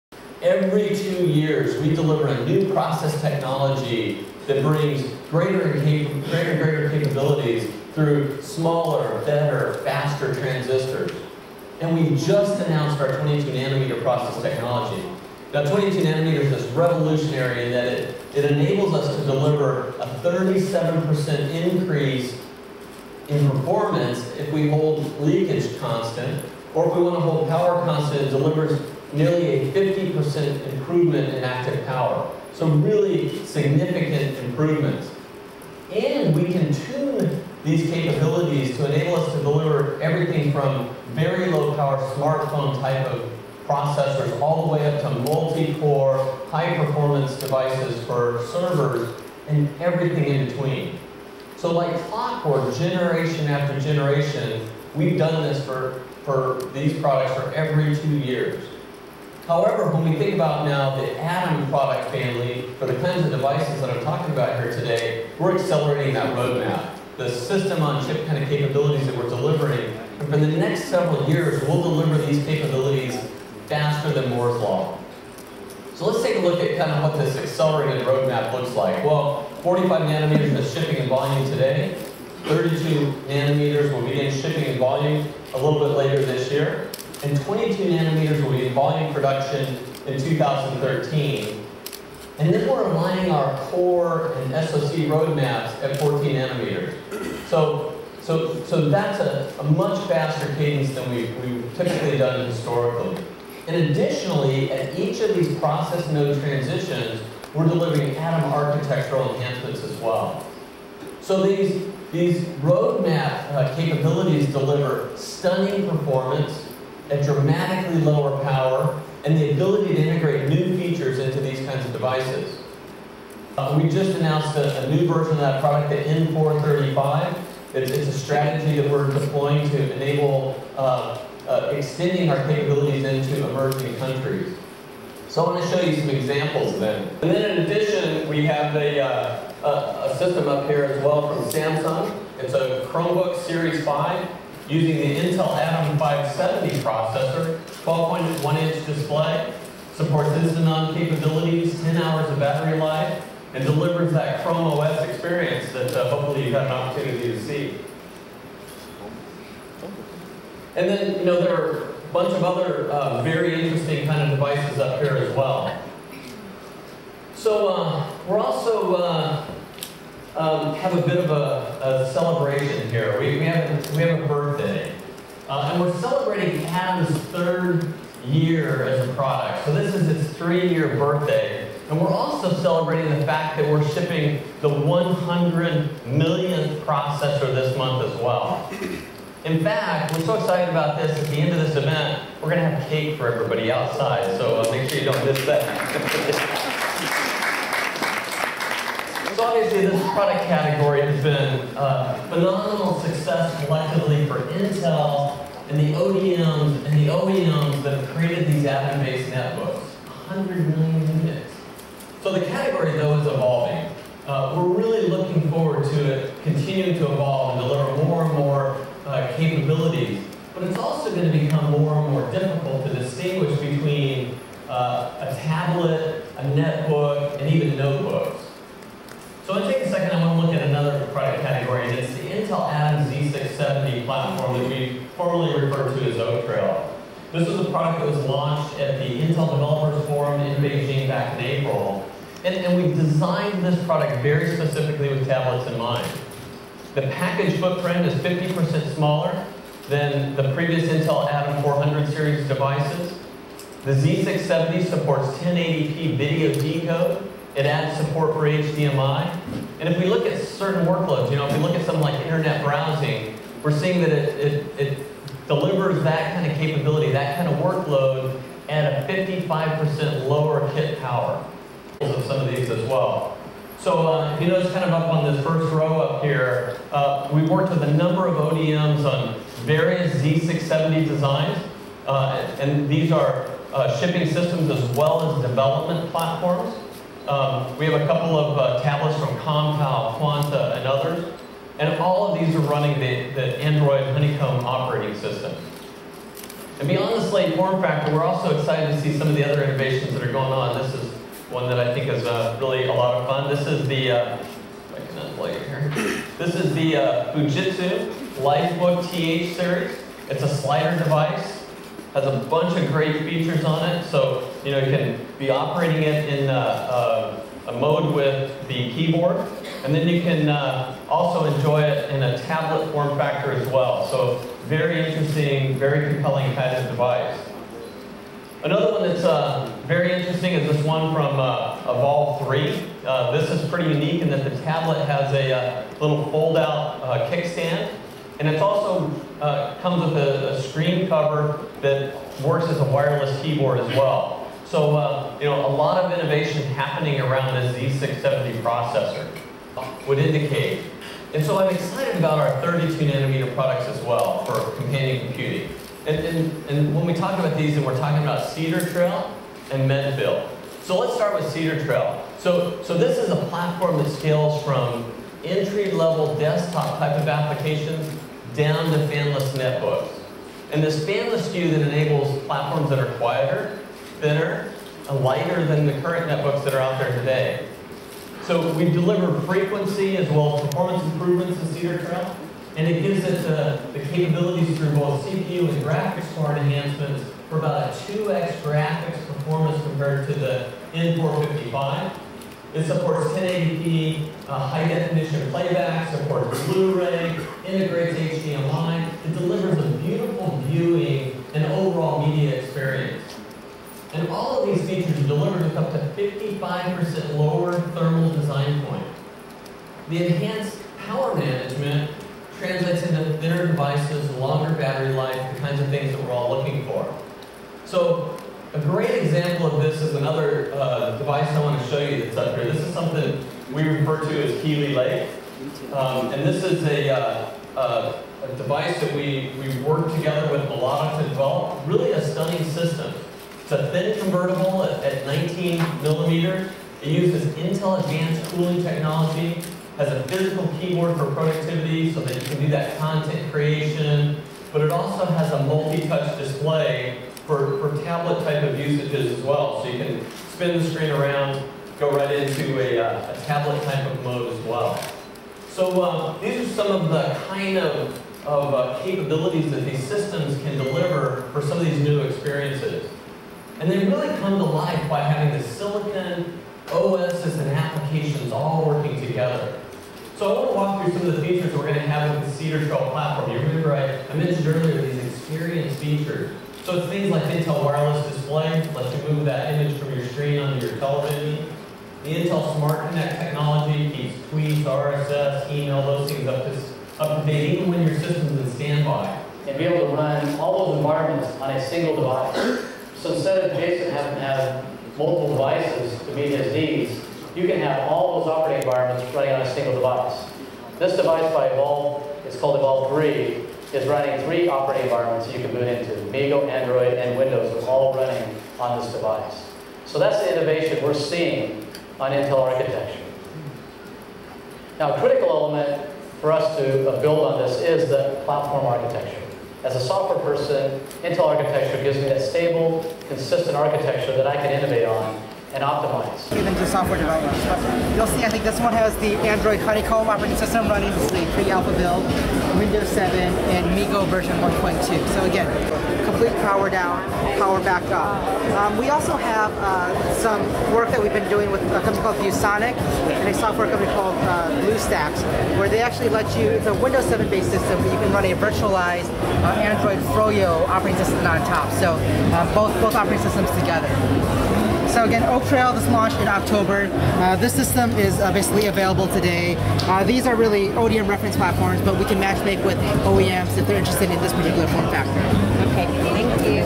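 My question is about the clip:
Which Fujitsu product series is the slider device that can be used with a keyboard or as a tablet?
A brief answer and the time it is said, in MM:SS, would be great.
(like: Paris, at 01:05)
Lifebook TH series, at 05:08.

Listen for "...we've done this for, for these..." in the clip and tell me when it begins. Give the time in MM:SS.
00:54.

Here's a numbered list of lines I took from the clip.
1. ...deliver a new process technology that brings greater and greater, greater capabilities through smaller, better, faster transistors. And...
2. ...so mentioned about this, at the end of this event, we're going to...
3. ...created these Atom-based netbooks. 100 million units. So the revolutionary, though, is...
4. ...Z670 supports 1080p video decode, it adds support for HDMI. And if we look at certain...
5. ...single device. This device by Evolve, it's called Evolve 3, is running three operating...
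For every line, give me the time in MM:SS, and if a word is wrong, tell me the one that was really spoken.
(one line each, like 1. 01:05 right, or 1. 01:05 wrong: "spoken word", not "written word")
1. 00:01 right
2. 03:10 wrong: "excited", not "mentioned"
3. 03:28 wrong: "category", not "revolutionary"
4. 04:13 right
5. 08:19 right.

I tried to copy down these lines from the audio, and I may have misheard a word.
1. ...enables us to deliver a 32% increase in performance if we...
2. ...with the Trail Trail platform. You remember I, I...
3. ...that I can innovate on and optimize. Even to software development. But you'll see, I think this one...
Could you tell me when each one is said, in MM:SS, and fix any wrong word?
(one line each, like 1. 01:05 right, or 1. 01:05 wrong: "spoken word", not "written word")
1. 00:18 wrong: "37", not "32"
2. 07:52 wrong: "Cedar", not "Trail"
3. 08:44 right.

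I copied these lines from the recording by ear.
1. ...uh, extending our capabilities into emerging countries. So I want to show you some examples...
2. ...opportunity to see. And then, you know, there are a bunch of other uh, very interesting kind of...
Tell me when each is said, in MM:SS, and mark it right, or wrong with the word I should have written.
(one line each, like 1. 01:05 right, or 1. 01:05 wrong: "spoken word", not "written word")
1. 02:11 right
2. 02:36 right.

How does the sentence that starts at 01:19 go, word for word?
Well, 45 nanometers is shipping in volume today.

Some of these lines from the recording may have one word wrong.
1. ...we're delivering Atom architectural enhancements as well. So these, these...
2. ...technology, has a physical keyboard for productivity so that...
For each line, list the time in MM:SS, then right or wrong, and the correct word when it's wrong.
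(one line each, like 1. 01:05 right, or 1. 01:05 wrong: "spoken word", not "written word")
1. 01:47 right
2. 07:18 right.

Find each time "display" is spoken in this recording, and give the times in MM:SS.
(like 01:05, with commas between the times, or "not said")
02:28, 07:26, 07:58.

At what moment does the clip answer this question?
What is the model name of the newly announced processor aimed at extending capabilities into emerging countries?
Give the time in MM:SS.
02:05.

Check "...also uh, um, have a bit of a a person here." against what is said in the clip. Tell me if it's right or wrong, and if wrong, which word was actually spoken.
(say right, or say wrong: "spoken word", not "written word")
wrong: "celebration", not "person".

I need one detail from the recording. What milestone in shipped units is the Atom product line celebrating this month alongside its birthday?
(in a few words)
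100 millionth processor.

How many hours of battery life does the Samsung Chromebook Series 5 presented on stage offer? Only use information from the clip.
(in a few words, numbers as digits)
10 hours.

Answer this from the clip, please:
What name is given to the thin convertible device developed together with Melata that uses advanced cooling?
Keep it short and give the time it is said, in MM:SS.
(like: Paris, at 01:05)
Keeley Lake, at 07:04.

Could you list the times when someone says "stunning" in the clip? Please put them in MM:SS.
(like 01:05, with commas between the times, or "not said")
01:55, 07:12.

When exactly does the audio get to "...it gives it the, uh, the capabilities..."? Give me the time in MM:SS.
06:22.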